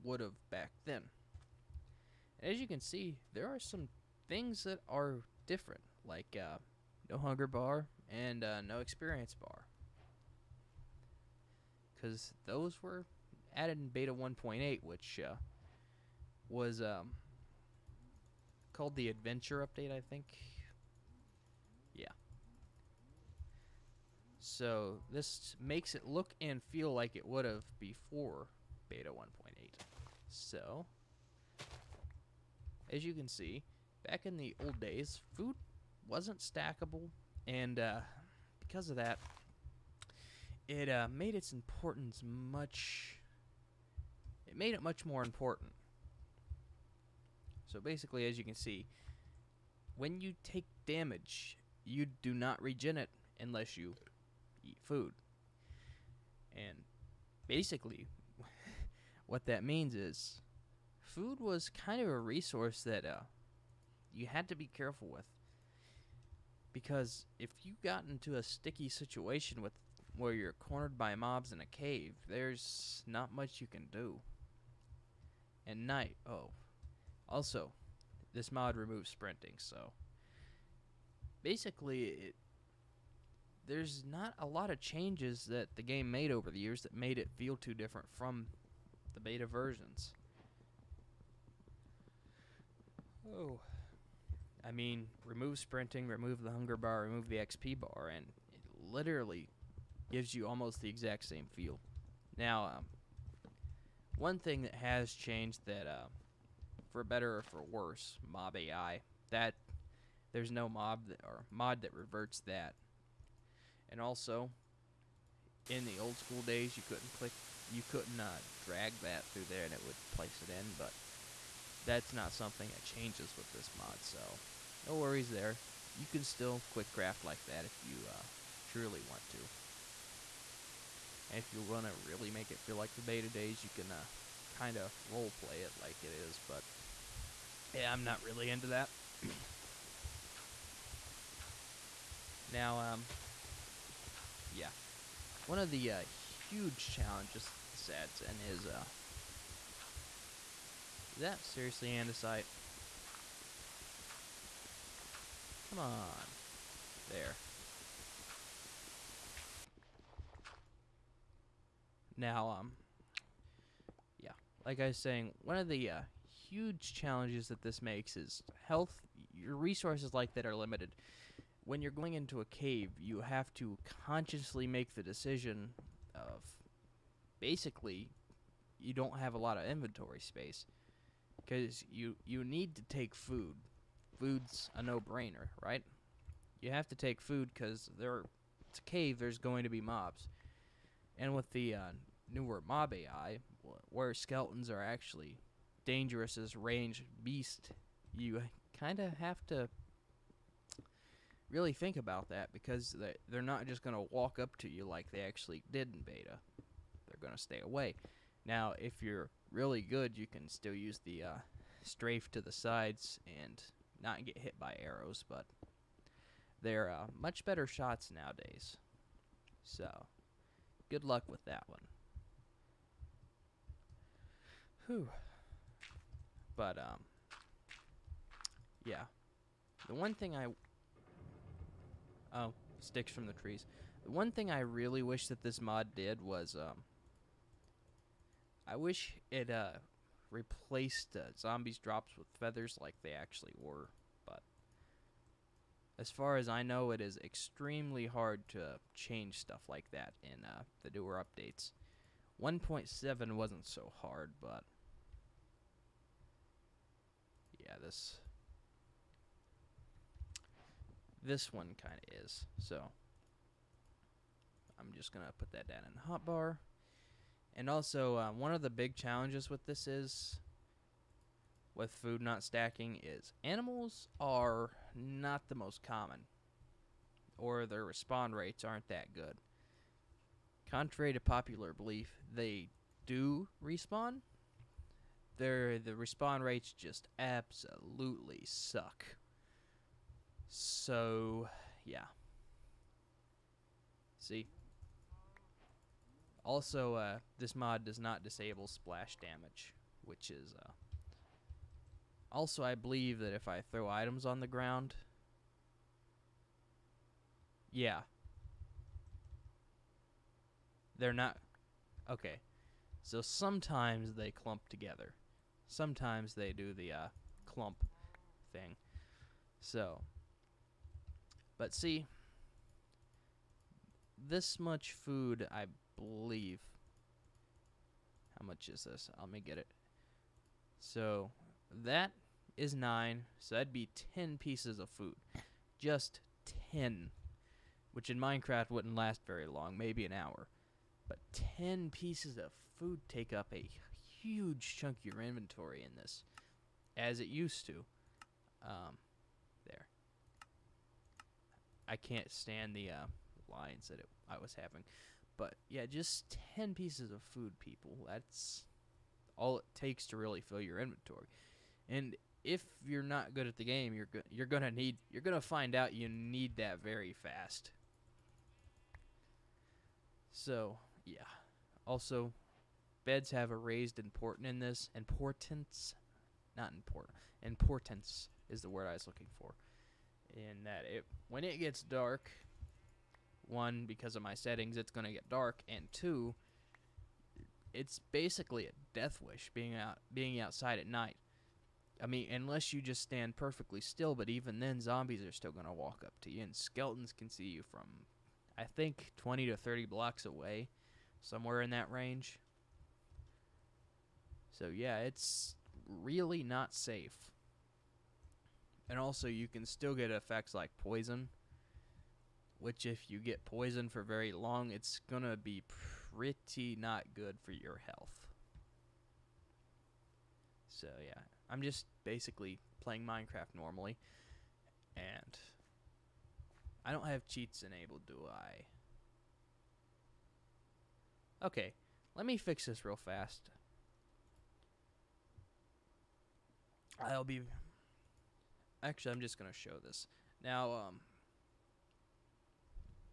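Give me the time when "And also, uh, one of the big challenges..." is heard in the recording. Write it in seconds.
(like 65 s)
267 s.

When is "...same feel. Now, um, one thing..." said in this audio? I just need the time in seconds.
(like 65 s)
101 s.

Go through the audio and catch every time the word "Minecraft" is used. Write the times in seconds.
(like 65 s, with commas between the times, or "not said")
338 s, 423 s.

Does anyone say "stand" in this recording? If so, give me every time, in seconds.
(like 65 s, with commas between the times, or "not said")
352 s, 393 s.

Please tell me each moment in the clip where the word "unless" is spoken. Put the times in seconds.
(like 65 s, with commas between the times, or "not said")
53 s, 392 s.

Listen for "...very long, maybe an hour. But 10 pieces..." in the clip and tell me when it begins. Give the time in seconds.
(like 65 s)
339 s.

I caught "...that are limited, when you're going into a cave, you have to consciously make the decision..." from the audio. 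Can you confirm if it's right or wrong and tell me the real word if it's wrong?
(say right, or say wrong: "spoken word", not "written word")
right.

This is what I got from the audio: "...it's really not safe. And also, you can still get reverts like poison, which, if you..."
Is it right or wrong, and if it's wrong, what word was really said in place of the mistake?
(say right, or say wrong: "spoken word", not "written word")
wrong: "effects", not "reverts".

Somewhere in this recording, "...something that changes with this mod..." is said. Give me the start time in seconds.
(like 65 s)
122 s.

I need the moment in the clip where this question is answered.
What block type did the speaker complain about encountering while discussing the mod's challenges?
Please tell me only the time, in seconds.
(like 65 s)
151 s.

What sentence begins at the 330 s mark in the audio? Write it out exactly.
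So that is 9, so that'd be 10 pieces of food.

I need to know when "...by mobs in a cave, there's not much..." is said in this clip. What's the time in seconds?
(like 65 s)
70 s.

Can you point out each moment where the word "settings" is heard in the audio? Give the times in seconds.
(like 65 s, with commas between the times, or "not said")
384 s.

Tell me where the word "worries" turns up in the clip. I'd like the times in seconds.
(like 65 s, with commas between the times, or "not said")
124 s.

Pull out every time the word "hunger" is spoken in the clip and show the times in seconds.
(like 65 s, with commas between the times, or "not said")
7 s, 96 s.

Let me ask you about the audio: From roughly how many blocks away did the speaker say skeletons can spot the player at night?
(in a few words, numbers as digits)
20 to 30.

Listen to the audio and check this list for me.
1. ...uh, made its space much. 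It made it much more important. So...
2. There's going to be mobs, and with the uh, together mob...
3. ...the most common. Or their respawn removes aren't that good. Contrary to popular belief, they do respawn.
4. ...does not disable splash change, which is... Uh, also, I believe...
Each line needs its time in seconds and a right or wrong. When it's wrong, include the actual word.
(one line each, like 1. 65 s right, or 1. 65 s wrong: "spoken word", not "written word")
1. 40 s wrong: "importance", not "space"
2. 189 s wrong: "newer", not "together"
3. 275 s wrong: "rates", not "removes"
4. 297 s wrong: "damage", not "change".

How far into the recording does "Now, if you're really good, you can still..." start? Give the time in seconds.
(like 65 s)
208 s.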